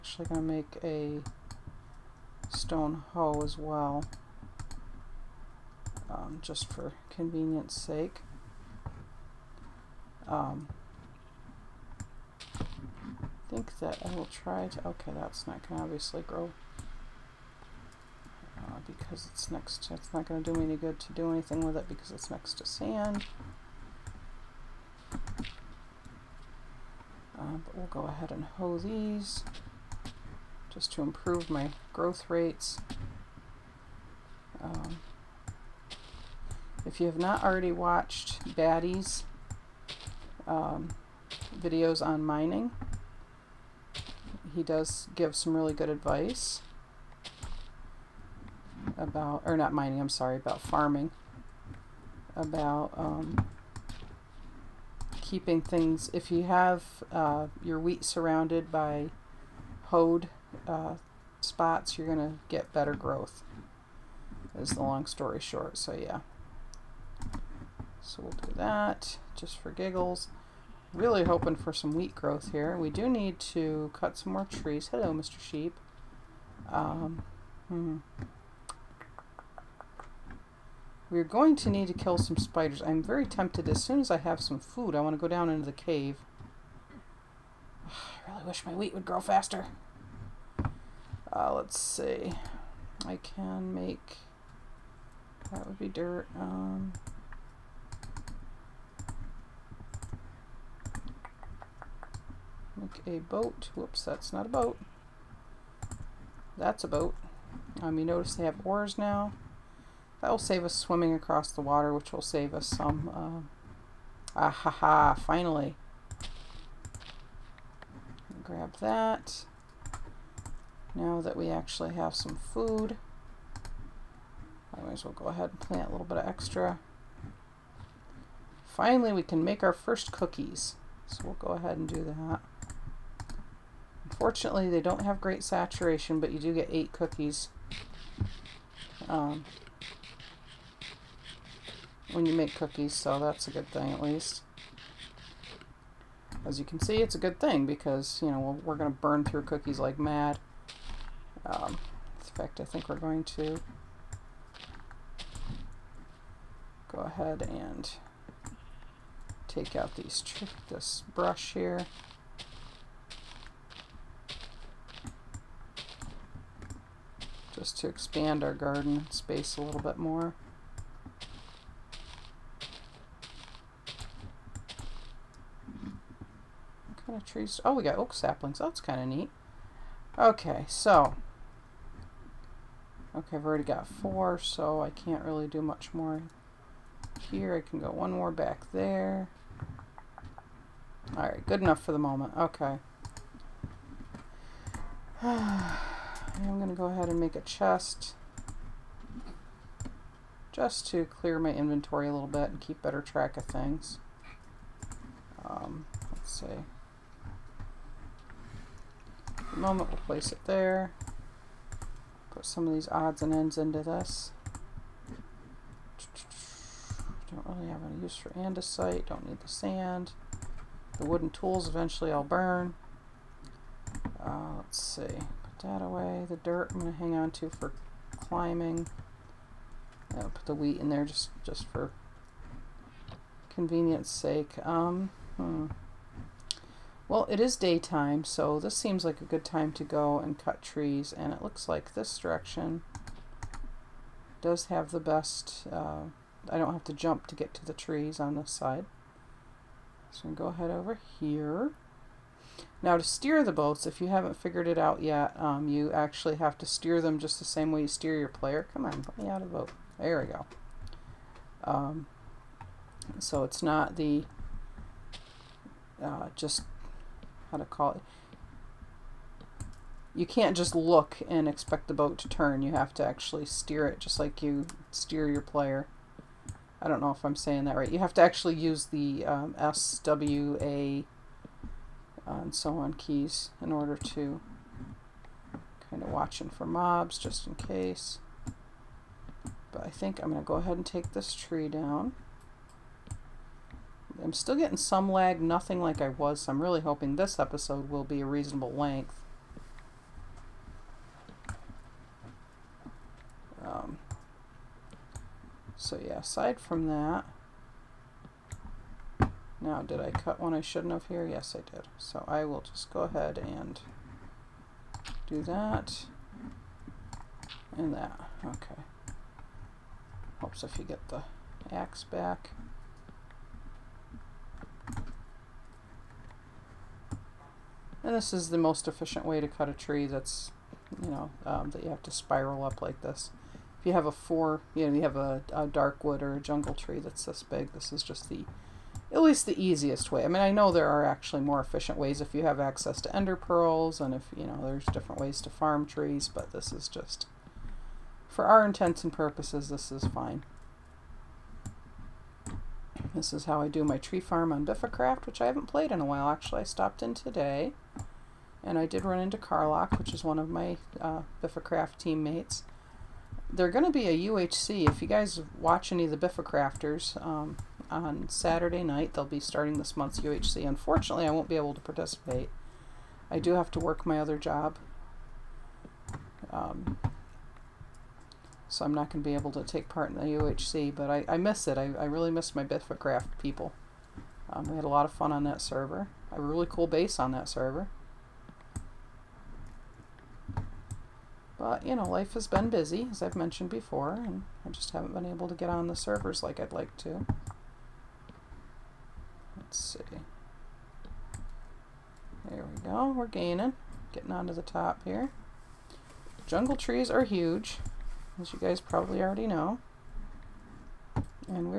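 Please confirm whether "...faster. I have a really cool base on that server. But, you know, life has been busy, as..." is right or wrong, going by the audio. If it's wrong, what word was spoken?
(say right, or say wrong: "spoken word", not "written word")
wrong: "server", not "faster".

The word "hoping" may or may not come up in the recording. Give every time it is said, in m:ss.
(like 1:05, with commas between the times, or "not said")
1:11, 4:56.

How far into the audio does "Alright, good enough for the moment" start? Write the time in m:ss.
3:11.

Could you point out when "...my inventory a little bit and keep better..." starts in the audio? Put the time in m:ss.
3:21.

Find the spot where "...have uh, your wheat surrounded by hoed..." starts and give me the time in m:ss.
0:56.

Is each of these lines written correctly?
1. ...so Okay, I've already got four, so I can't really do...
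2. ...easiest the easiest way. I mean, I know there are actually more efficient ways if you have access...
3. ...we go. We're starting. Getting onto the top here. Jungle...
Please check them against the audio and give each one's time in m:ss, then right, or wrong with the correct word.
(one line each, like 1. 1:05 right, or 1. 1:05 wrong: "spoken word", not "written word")
1. 3:00 right
2. 5:39 wrong: "least", not "easiest"
3. 6:42 wrong: "gaining", not "starting".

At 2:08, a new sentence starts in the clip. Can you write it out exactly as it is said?
Finally, we can make our first cookies.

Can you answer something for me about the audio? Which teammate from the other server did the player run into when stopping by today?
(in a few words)
Carlock.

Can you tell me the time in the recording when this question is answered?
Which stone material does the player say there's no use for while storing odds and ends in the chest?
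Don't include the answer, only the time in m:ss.
3:38.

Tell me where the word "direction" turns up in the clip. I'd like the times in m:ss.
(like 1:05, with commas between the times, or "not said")
4:02.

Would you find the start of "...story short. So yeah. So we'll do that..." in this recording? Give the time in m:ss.
1:05.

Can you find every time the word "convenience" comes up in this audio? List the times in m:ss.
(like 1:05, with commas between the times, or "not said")
0:07, 3:53.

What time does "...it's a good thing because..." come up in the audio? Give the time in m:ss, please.
2:26.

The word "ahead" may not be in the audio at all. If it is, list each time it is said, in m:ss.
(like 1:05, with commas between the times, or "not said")
0:28, 2:05, 2:11, 2:37, 3:16, 4:10, 4:50, 5:13.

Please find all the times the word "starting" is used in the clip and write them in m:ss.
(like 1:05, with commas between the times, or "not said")
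6:09.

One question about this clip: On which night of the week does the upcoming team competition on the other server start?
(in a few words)
Saturday.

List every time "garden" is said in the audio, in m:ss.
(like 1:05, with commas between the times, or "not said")
2:48.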